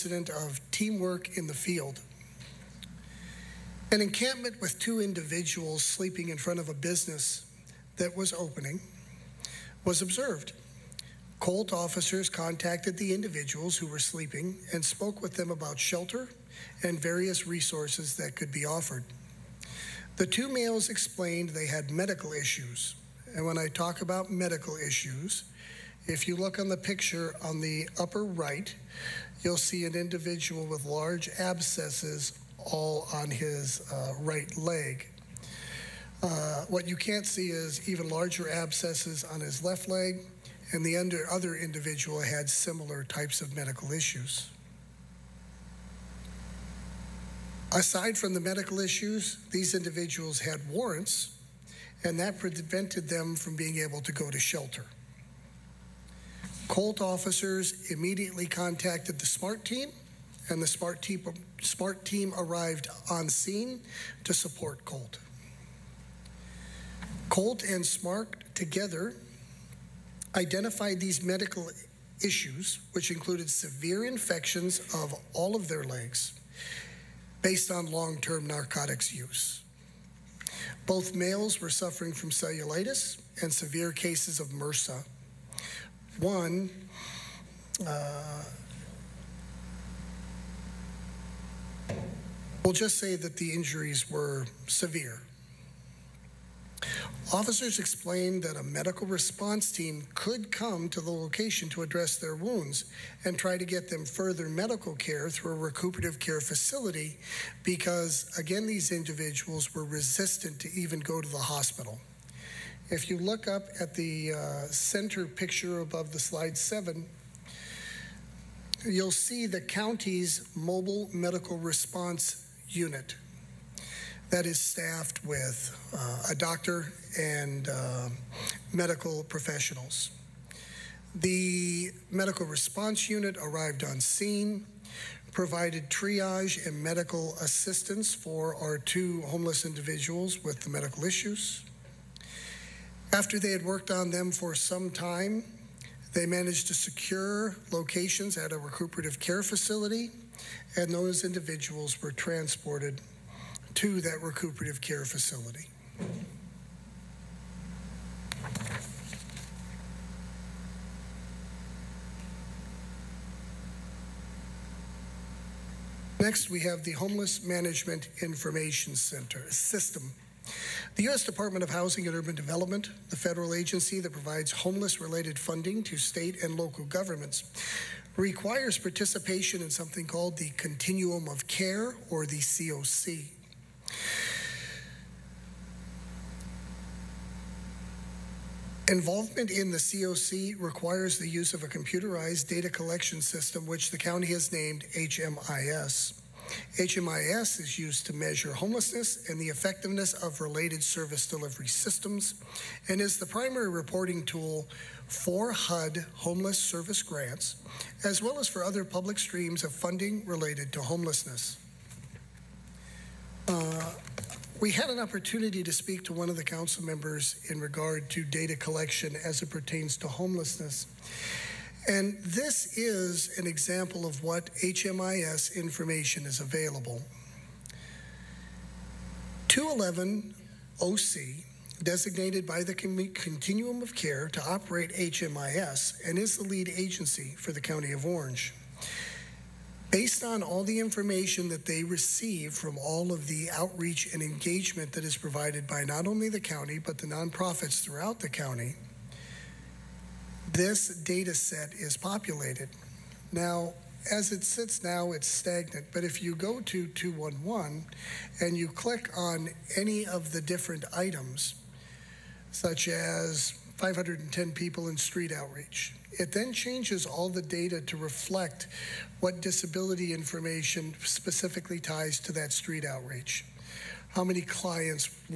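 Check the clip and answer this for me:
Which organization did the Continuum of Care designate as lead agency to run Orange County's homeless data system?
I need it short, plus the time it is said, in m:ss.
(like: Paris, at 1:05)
211 OC, at 3:49.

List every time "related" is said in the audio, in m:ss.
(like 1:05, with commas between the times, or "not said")
2:54, 3:20, 3:30.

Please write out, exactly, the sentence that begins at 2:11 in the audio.
The medical response unit arrived on scene, provided triage and medical assistance for our two homeless individuals with the medical issues.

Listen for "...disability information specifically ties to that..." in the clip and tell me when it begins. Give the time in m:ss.
4:29.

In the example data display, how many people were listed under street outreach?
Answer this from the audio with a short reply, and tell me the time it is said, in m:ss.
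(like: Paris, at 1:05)
510, at 4:23.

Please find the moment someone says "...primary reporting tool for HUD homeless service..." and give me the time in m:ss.
3:23.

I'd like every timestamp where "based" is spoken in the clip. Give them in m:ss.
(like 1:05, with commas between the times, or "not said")
1:17, 3:59.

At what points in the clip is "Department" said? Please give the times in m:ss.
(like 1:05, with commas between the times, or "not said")
2:51.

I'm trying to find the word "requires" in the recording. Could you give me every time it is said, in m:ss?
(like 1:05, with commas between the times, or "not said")
2:58, 3:10.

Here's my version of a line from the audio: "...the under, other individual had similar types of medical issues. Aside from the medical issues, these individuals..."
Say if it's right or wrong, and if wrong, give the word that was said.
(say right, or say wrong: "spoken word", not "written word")
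right.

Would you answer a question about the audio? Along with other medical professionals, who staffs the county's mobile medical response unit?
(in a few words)
A doctor.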